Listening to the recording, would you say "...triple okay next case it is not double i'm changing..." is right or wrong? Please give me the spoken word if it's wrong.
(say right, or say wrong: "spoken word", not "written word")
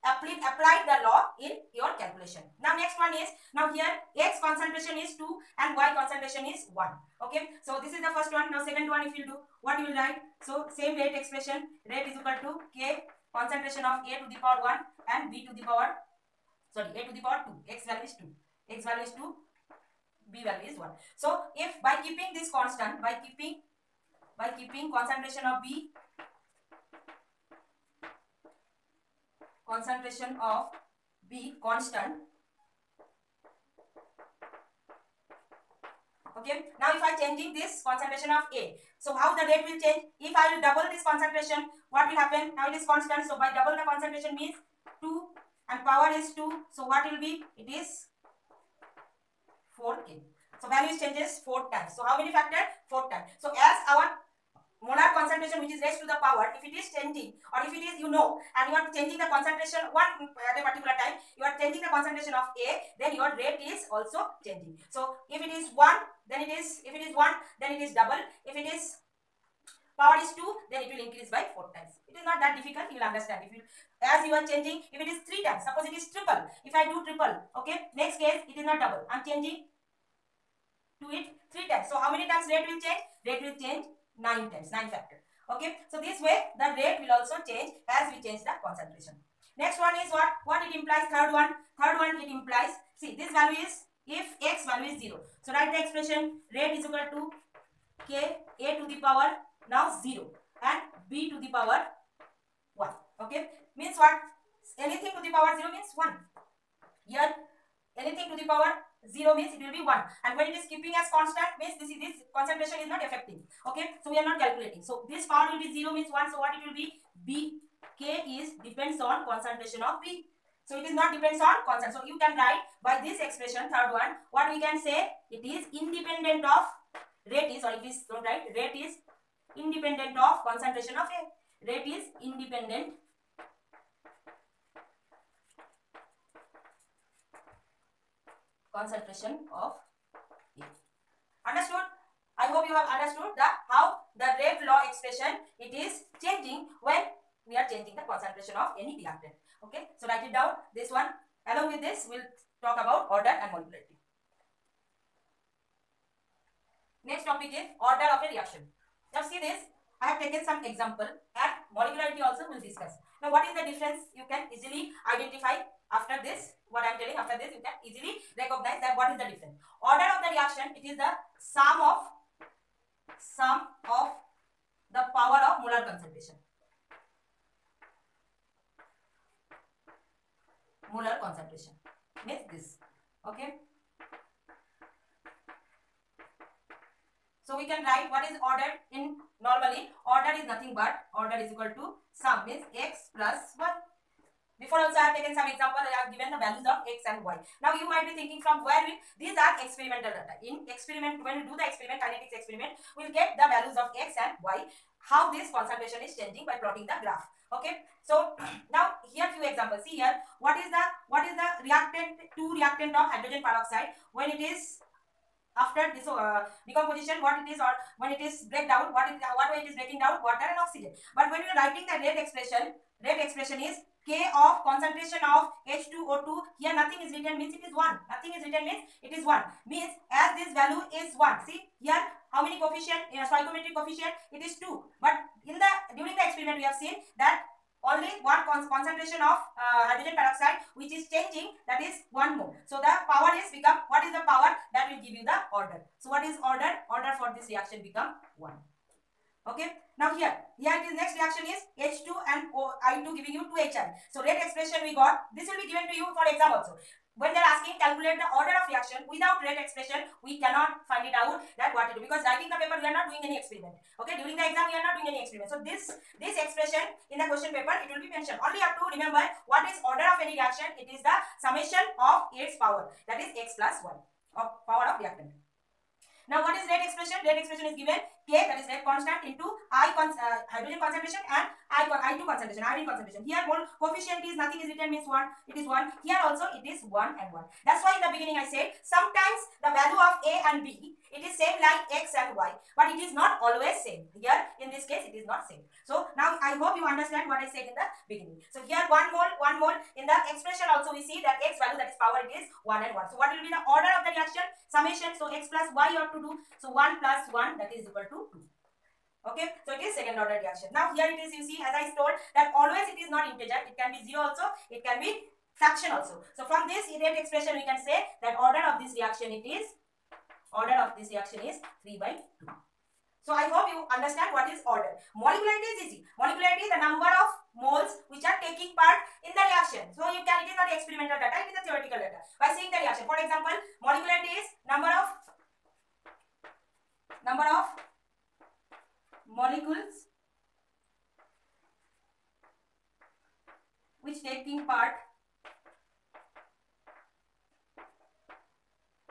right.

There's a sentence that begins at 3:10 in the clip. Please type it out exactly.
Order is nothing but order is equal to sum means x plus 1.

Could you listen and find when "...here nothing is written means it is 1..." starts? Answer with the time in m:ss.
3:46.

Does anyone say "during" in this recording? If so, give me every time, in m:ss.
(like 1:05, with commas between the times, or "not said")
3:55, 4:24.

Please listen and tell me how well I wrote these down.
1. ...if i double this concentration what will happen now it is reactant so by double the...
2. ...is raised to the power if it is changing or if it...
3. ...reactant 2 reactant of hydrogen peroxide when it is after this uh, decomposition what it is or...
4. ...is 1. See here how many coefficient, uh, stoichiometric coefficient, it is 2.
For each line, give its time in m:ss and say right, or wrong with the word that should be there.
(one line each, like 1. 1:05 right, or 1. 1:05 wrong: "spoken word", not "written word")
1. 0:40 wrong: "constant", not "reactant"
2. 0:55 right
3. 3:31 right
4. 3:51 right.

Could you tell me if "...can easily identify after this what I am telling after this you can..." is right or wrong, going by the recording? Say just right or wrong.
right.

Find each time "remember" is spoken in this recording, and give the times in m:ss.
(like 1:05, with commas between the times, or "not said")
4:28.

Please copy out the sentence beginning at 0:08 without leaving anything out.
Now second one if you do, what you will write?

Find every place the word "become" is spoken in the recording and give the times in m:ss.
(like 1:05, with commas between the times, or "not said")
4:03, 4:07.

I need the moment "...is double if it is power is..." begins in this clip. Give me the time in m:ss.
1:07.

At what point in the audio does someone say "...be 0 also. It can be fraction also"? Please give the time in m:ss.
5:13.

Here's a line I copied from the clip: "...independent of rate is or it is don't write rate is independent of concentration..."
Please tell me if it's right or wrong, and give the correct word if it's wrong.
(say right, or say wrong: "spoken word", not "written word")
right.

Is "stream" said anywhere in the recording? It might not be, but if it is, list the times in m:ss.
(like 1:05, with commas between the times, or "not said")
not said.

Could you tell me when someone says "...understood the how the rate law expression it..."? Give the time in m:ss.
2:22.